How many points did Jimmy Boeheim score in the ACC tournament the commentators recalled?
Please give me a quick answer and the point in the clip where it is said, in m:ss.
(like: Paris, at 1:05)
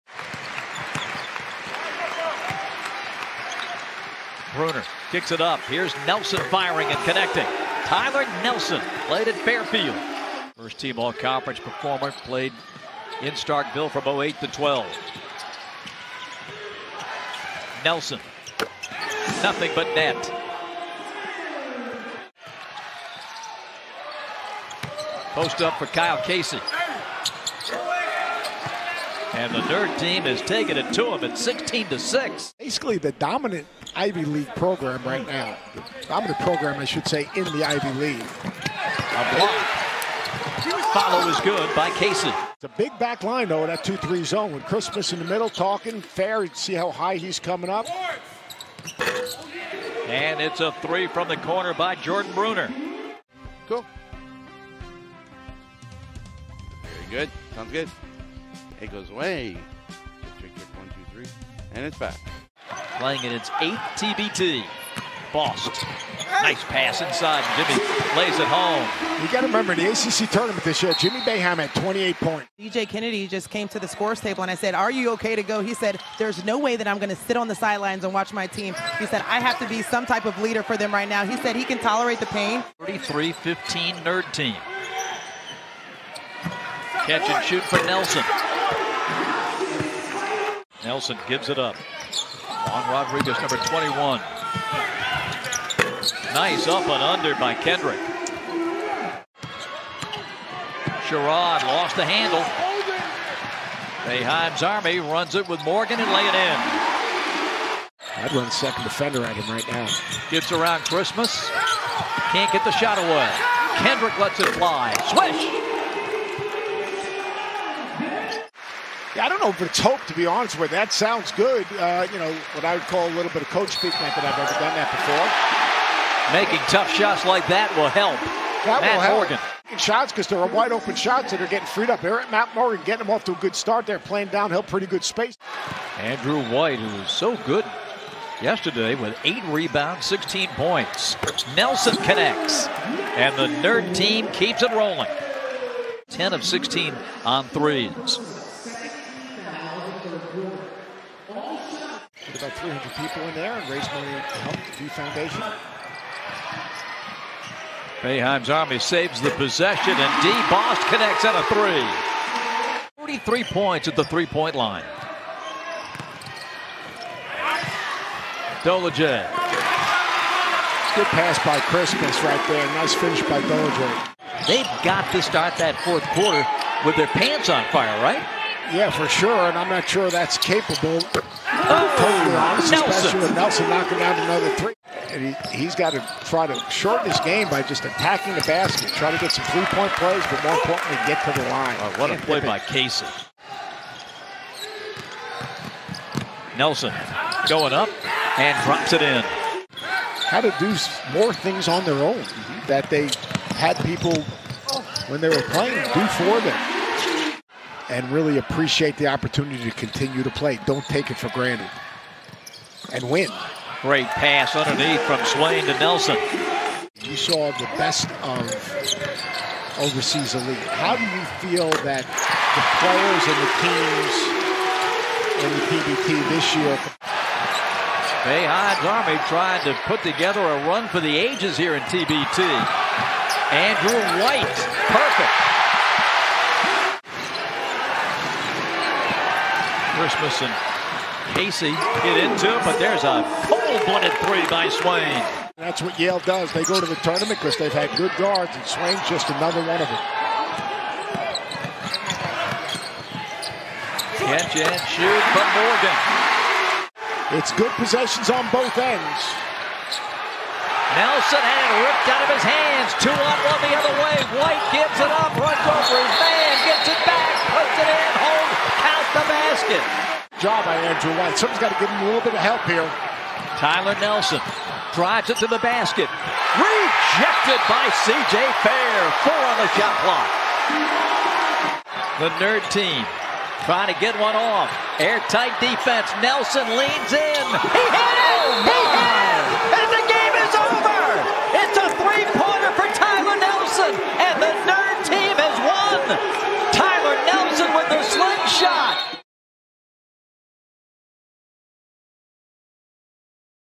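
28, at 1:11.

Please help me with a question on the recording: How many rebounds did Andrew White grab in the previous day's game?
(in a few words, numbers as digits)
8.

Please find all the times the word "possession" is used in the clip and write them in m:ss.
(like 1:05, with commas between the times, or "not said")
2:39, 4:17.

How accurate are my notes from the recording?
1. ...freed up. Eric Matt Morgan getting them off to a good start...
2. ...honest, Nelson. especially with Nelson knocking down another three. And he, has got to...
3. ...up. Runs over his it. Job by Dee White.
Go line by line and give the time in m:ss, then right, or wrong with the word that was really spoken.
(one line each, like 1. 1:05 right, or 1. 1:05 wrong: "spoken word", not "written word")
1. 2:11 right
2. 3:02 right
3. 4:25 wrong: "Andrew", not "Dee".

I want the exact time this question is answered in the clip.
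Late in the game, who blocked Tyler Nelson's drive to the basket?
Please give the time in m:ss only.
4:38.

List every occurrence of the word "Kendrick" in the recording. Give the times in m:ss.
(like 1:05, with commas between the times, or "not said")
1:37, 1:53.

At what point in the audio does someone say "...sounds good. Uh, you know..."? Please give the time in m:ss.
2:00.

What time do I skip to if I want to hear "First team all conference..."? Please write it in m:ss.
0:10.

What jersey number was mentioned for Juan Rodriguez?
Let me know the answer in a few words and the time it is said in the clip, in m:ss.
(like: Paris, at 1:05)
21, at 1:33.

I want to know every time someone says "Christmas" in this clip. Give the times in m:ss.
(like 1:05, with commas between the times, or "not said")
0:44, 1:50, 2:51, 4:00.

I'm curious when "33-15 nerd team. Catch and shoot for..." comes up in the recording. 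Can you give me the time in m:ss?
1:22.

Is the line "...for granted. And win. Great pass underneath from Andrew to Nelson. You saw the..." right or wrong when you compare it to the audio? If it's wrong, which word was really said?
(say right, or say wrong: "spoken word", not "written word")
wrong: "Swain", not "Andrew".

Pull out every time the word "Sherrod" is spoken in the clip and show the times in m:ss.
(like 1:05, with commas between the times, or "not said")
1:41.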